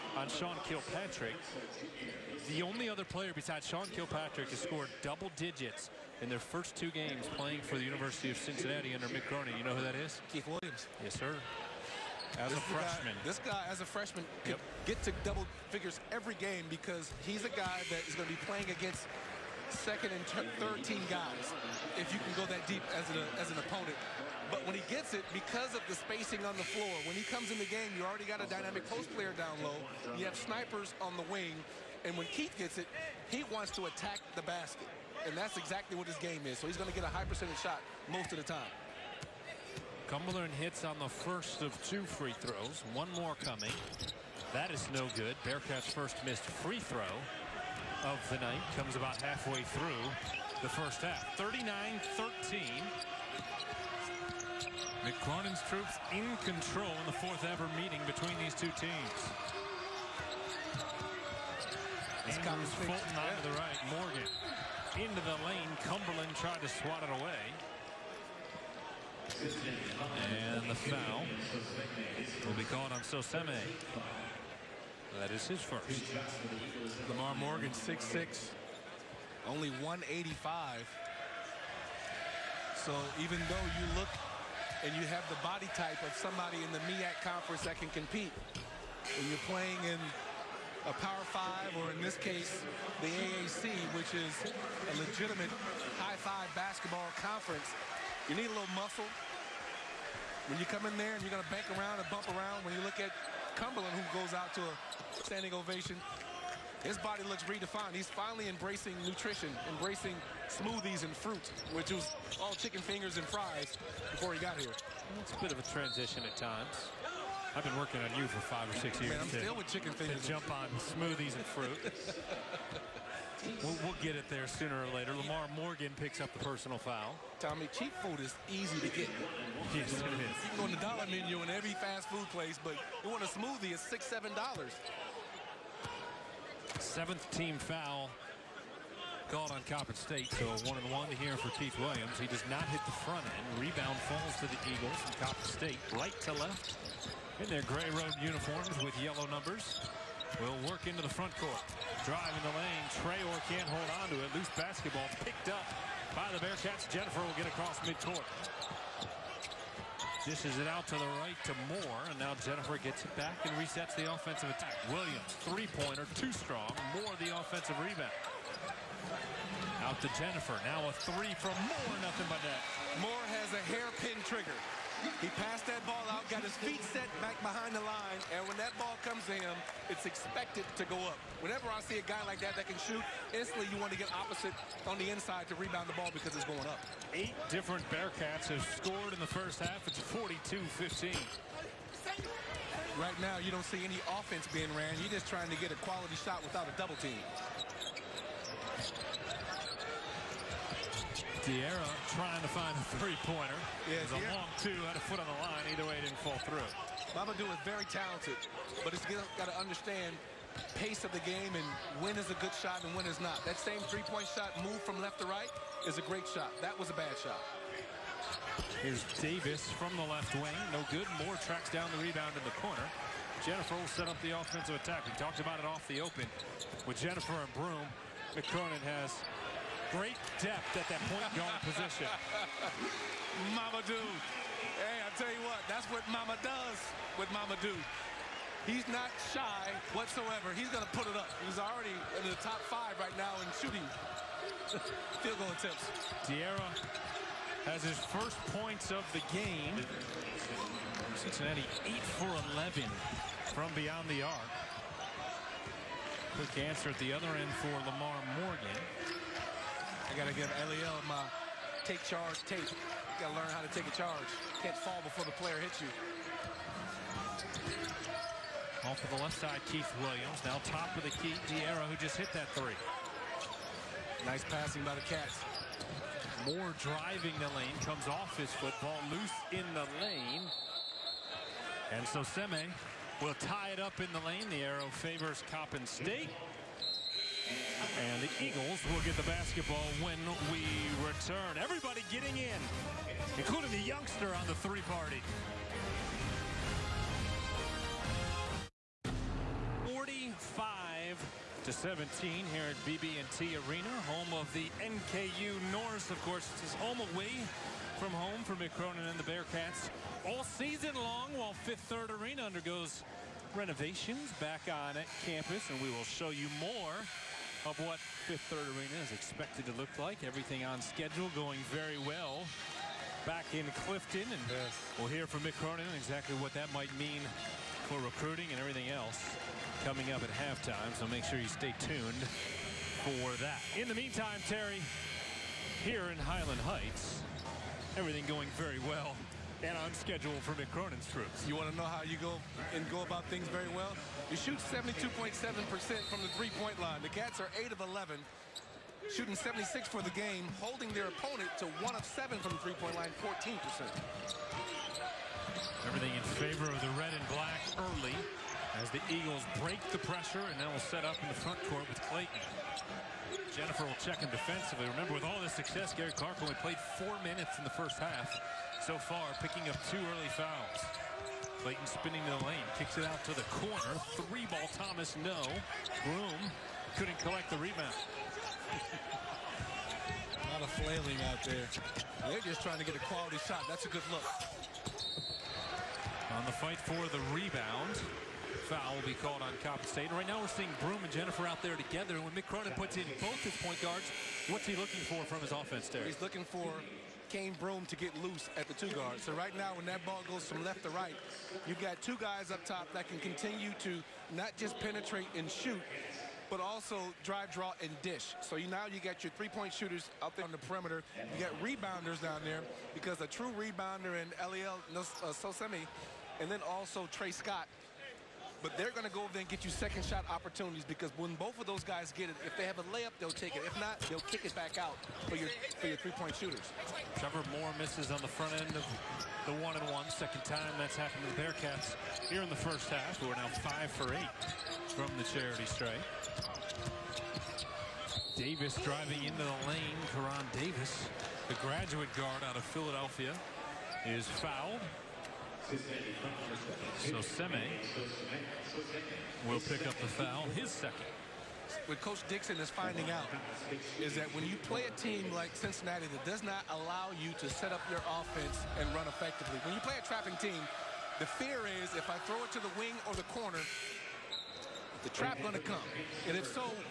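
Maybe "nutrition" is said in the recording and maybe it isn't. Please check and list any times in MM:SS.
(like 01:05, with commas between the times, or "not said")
01:49.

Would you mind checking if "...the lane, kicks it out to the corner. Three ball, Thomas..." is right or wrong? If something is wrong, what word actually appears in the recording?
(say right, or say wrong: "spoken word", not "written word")
right.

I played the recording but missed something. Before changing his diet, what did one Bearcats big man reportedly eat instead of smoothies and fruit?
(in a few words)
chicken fingers and fries.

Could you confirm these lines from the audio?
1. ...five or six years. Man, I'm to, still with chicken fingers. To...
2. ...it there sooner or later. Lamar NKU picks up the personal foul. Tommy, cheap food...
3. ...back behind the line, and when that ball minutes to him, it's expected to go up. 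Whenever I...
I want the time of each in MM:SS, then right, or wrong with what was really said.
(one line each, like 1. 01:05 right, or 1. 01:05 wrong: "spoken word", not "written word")
1. 01:58 right
2. 02:04 wrong: "Morgan", not "NKU"
3. 02:57 wrong: "comes", not "minutes".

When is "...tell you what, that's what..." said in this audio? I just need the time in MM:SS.
03:55.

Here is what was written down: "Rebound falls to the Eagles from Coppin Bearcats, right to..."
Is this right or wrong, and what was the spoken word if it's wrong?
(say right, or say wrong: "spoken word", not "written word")
wrong: "State", not "Bearcats".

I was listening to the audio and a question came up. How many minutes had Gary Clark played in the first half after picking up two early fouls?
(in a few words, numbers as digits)
4.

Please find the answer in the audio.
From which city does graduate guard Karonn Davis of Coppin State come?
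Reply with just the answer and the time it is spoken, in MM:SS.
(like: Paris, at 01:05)
Philadelphia, at 07:22.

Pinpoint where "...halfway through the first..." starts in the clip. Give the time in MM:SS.
00:49.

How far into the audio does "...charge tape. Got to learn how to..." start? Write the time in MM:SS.
04:22.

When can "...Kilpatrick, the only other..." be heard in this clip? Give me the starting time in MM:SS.
00:00.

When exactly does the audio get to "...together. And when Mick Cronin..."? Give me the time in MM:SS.
06:31.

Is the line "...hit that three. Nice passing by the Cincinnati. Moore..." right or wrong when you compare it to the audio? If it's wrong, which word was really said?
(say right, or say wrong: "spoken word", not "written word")
wrong: "Cats", not "Cincinnati".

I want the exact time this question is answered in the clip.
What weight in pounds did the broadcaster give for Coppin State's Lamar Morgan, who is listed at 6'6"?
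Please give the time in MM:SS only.
01:19.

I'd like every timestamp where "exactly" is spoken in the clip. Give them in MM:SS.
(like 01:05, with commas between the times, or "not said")
00:35, 05:25.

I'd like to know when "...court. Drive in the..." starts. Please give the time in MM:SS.
02:31.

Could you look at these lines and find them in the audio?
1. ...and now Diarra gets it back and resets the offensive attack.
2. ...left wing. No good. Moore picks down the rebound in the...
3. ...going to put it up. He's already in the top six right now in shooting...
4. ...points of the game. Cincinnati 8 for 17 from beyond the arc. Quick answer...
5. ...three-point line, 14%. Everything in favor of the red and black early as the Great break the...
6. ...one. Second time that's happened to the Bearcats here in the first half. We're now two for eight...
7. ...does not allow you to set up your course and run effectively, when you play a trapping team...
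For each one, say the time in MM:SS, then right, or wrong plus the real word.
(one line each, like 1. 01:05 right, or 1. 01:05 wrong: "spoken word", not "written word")
1. 02:42 wrong: "Jenifer", not "Diarra"
2. 03:40 wrong: "tracks", not "picks"
3. 04:00 wrong: "five", not "six"
4. 04:08 wrong: "11", not "17"
5. 05:52 wrong: "Eagles", not "Great"
6. 07:09 wrong: "five", not "two"
7. 07:36 wrong: "offense", not "course".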